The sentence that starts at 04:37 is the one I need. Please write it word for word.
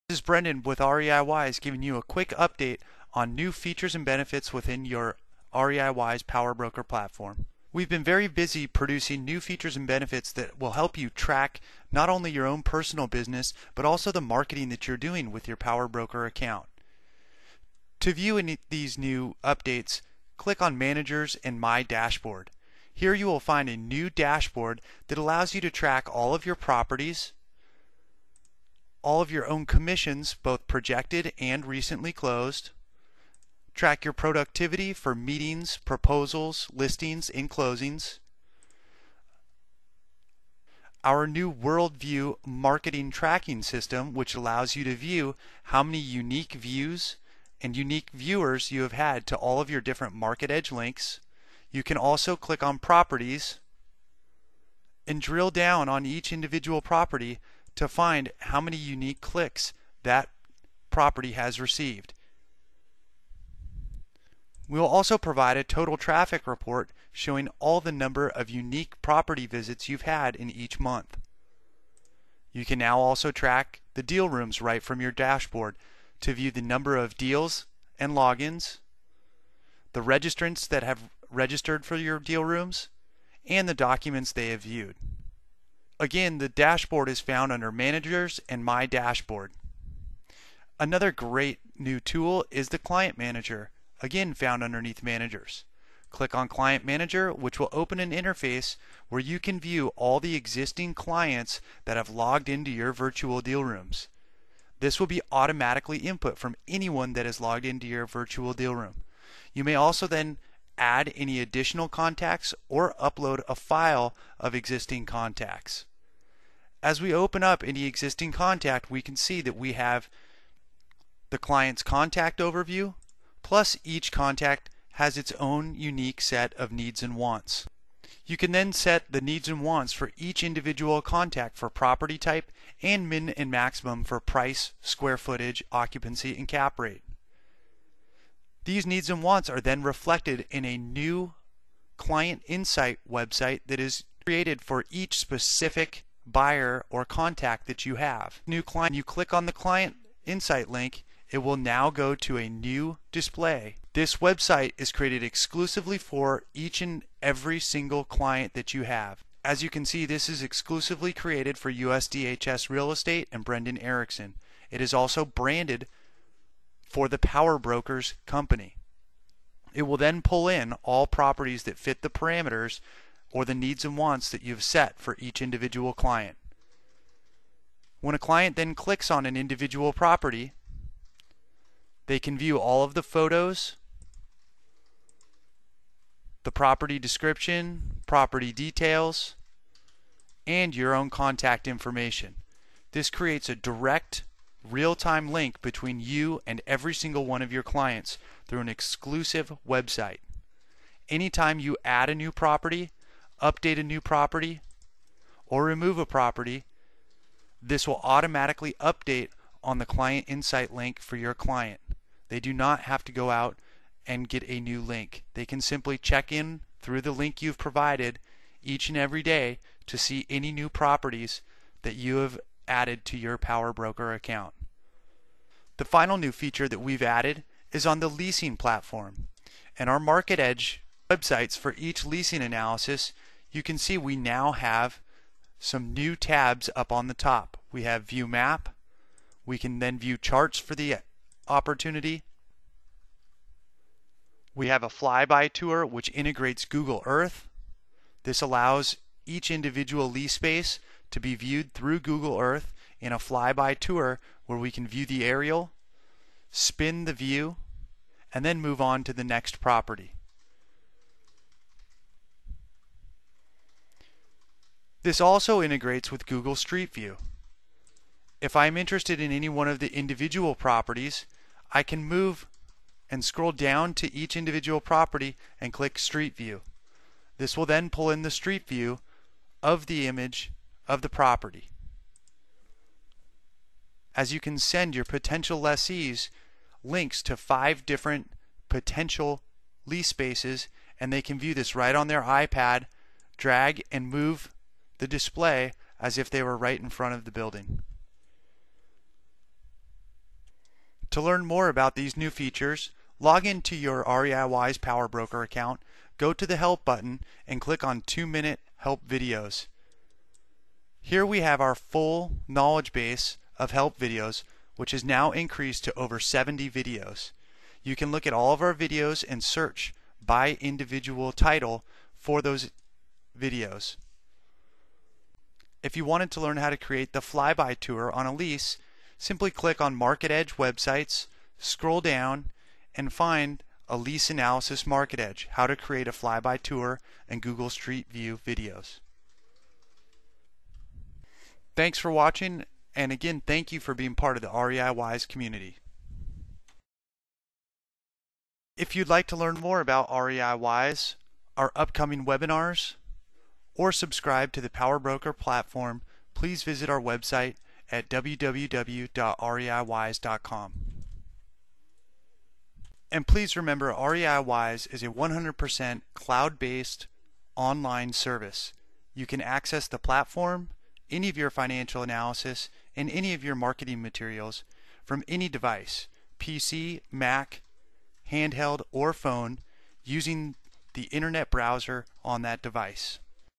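This will then pull in the Street View of the image of the property.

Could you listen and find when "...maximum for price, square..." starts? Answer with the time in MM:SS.
02:13.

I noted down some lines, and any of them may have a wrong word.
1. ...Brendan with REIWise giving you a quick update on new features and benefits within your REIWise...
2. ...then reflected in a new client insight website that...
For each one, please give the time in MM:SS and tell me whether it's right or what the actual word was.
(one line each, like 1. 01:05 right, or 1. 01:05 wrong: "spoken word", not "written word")
1. 00:00 right
2. 02:19 right.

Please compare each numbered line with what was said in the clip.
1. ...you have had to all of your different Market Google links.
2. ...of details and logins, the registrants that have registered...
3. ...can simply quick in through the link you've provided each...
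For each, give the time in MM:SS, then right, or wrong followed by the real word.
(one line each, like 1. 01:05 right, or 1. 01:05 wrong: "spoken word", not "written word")
1. 00:48 wrong: "Edge", not "Google"
2. 01:16 wrong: "deals", not "details"
3. 03:35 wrong: "check", not "quick".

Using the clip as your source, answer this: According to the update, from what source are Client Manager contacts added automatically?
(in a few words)
Virtual deal rooms.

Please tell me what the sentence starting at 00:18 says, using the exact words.
To view any these new updates, click on Managers and My Dashboard.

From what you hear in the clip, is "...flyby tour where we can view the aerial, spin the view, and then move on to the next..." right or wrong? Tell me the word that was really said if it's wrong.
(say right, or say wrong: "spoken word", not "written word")
right.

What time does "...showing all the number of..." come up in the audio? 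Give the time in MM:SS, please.
01:07.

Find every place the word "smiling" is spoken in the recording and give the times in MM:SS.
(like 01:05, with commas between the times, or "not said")
not said.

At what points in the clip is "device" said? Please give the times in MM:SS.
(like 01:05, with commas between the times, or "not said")
06:15, 06:22.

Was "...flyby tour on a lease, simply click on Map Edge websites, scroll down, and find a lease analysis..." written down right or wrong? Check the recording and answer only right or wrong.
wrong.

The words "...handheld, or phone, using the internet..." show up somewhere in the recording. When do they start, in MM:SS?
06:18.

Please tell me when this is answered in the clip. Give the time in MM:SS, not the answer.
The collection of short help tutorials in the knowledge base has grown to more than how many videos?
05:16.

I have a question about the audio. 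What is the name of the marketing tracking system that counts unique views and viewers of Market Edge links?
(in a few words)
Worldview.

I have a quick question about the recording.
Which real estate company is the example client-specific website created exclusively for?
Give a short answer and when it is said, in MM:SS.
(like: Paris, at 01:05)
USDHS Real Estate, at 02:41.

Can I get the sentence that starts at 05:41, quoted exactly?
Thanks for watching, and again, thank you for being part of the REI Wise community.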